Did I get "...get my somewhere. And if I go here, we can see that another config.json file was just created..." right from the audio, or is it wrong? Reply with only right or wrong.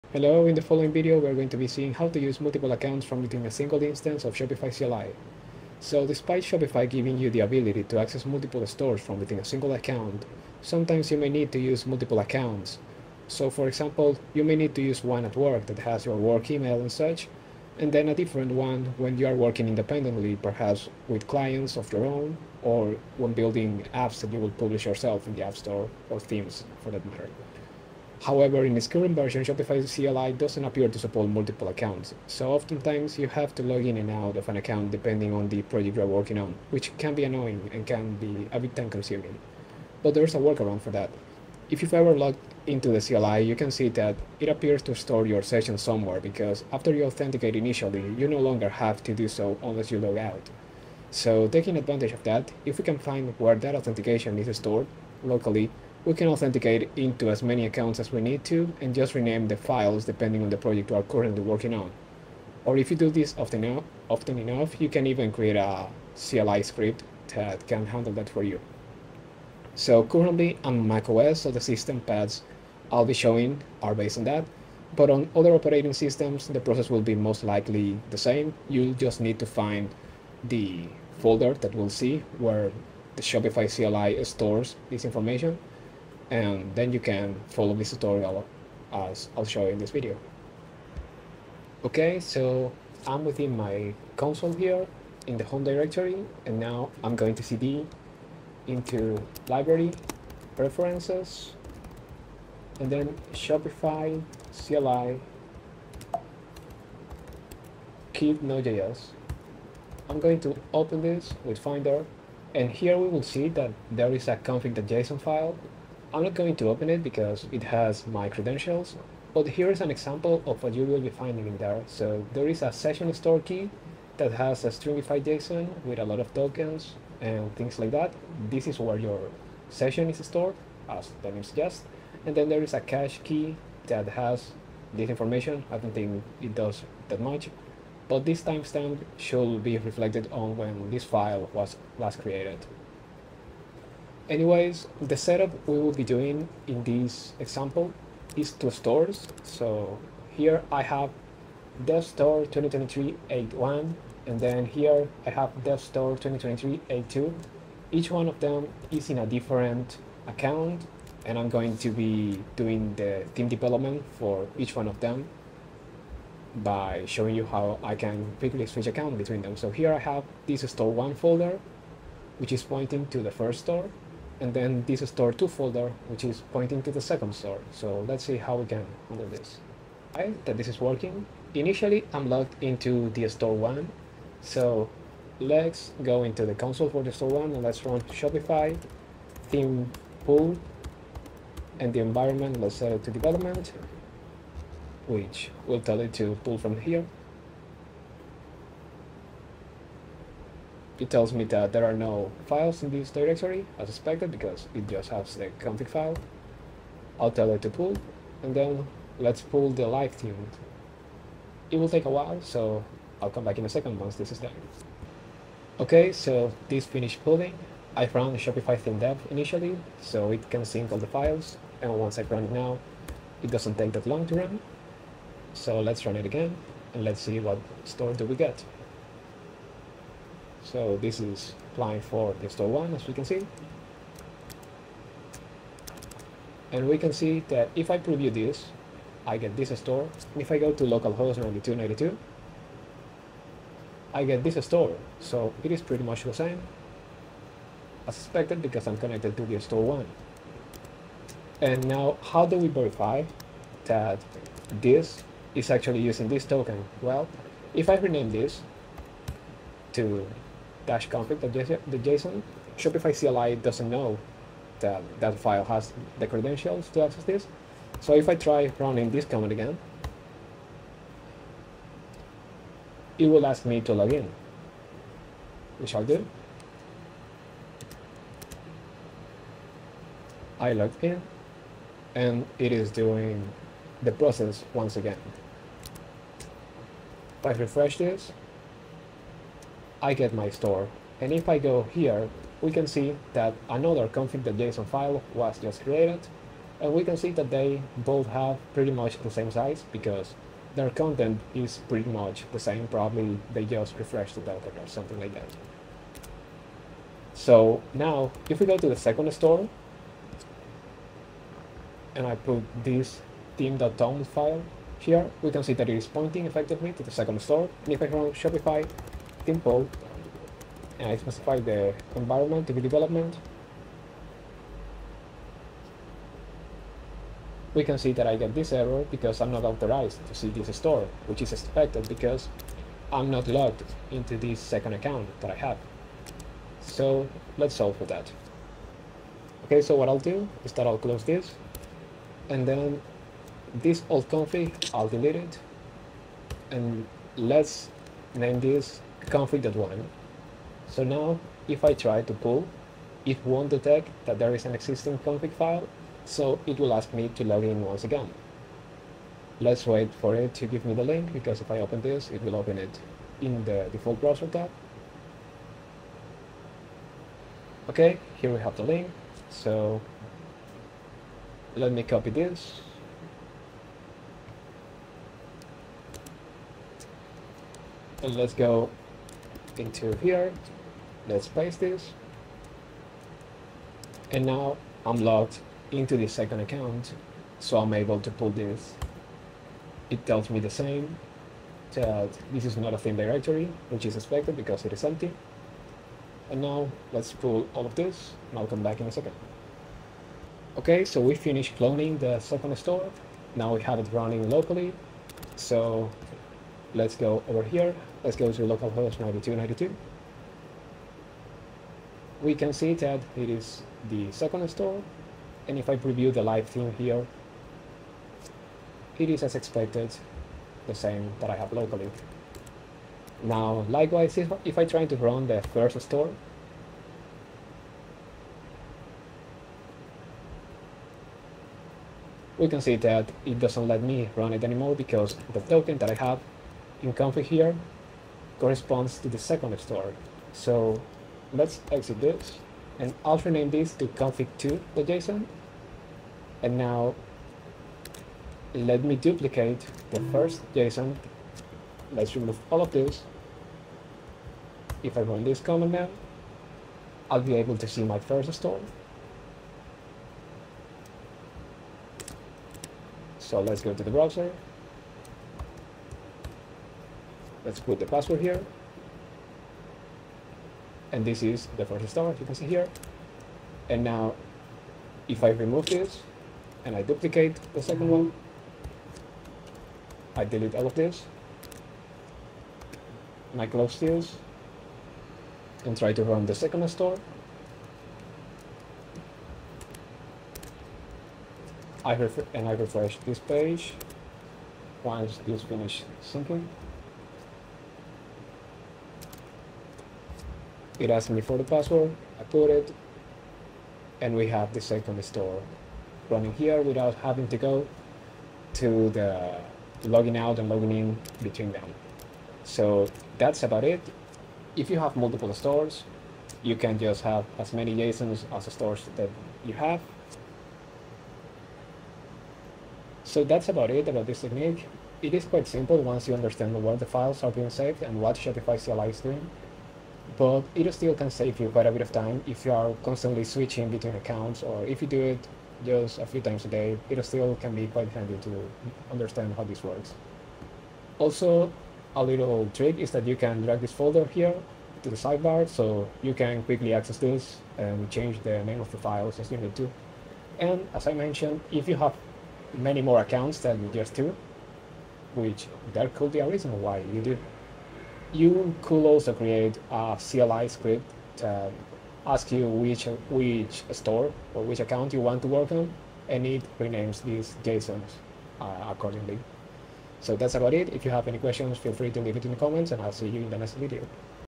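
wrong.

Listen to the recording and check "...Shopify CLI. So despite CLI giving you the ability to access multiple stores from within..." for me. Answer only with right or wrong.
wrong.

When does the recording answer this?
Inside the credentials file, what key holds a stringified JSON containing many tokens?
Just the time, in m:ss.
2:02.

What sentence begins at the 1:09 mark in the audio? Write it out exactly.
So currently on macOS, so the system paths I'll be showing are based on that.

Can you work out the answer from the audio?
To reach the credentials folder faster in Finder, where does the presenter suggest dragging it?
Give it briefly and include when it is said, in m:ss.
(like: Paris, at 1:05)
the sidebar, at 9:05.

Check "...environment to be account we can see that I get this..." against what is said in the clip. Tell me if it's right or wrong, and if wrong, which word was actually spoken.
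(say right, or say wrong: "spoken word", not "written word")
wrong: "development", not "account".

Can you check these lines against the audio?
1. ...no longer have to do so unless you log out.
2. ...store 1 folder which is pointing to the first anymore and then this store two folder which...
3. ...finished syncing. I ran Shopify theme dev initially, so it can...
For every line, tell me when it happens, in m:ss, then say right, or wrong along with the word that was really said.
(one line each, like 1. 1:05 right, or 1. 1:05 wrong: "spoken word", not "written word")
1. 0:48 right
2. 2:50 wrong: "store", not "anymore"
3. 3:36 wrong: "pulling", not "syncing".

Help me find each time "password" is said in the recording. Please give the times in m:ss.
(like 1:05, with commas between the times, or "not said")
7:48, 8:21.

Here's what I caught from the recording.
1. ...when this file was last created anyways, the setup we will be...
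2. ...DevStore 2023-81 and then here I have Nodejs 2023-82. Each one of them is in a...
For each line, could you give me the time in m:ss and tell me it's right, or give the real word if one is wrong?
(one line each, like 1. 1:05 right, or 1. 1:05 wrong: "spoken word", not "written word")
1. 2:20 right
2. 2:31 wrong: "DevStore", not "Nodejs".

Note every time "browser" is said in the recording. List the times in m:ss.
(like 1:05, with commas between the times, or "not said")
6:04, 7:44.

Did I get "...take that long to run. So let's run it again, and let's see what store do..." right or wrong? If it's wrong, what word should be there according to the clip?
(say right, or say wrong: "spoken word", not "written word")
right.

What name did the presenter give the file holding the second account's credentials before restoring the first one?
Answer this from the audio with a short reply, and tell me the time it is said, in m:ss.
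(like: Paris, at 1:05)
config2.json, at 7:24.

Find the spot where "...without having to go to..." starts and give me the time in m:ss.
8:26.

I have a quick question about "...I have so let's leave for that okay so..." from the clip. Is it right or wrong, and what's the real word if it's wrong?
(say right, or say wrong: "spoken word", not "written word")
wrong: "solve", not "leave".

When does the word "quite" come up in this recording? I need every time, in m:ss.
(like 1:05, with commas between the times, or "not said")
8:45, 8:51, 8:57.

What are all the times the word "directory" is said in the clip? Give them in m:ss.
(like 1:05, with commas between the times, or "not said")
1:35, 3:23, 6:33.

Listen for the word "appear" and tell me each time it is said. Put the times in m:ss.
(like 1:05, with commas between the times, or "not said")
0:30, 0:44.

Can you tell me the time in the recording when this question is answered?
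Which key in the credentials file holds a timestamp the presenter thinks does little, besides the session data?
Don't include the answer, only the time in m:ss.
2:12.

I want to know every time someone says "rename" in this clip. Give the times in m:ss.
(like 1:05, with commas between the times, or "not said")
0:59, 4:17, 7:23, 9:26.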